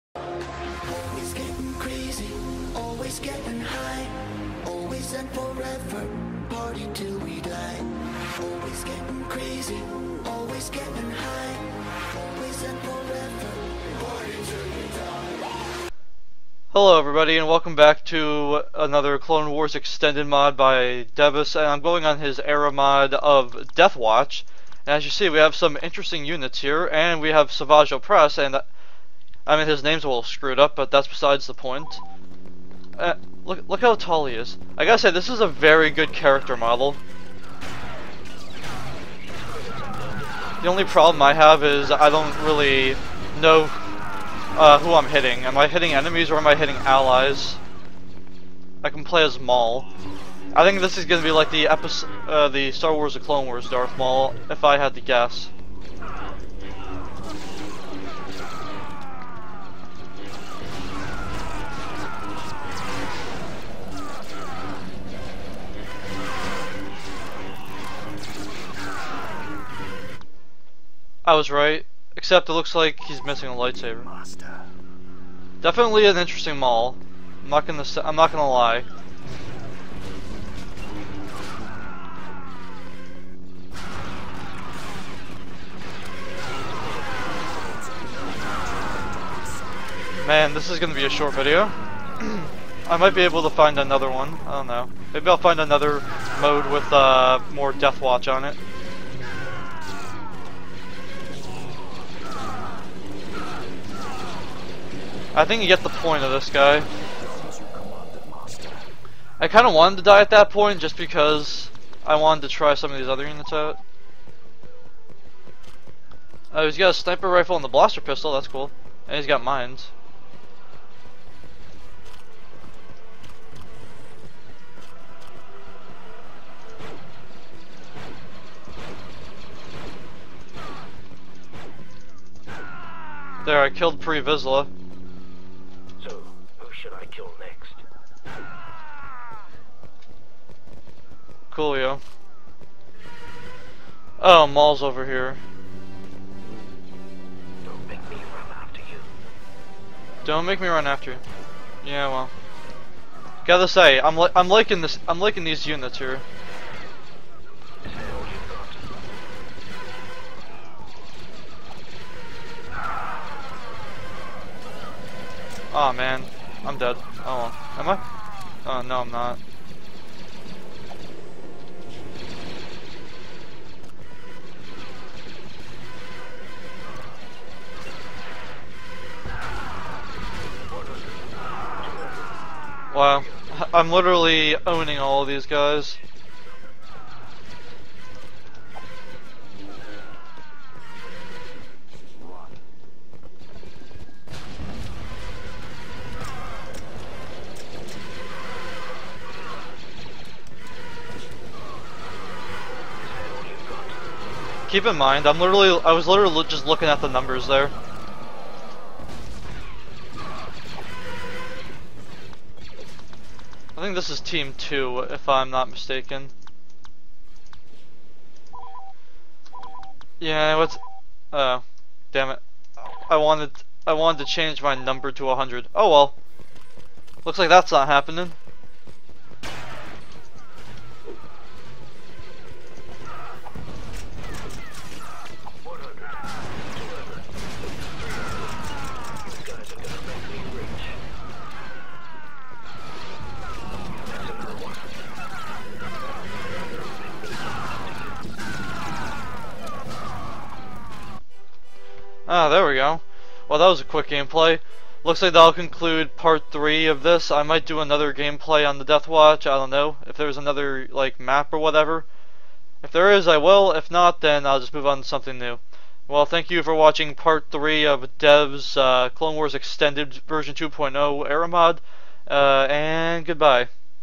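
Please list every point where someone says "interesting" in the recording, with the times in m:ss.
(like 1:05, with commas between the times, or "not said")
0:25, 1:16.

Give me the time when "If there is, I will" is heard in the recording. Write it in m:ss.
4:22.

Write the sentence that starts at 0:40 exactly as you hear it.
The only problem I have is I don't really know uh, who I'm hitting.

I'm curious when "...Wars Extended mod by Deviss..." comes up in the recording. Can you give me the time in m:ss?
0:19.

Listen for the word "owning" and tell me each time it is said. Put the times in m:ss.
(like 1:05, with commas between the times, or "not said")
3:04.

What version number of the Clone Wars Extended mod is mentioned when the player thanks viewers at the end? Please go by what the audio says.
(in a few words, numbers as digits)
2.0.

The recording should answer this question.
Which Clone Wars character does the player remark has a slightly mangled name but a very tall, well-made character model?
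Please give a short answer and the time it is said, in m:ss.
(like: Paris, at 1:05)
Savage Oppress, at 0:27.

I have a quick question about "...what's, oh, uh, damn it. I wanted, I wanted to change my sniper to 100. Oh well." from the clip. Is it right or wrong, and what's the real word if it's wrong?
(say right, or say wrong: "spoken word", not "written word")
wrong: "number", not "sniper".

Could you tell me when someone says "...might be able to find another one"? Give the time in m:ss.
1:32.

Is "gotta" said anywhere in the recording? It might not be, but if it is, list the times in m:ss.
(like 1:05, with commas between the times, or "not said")
0:34, 2:33.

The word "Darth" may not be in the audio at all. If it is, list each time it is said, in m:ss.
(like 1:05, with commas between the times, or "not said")
0:53.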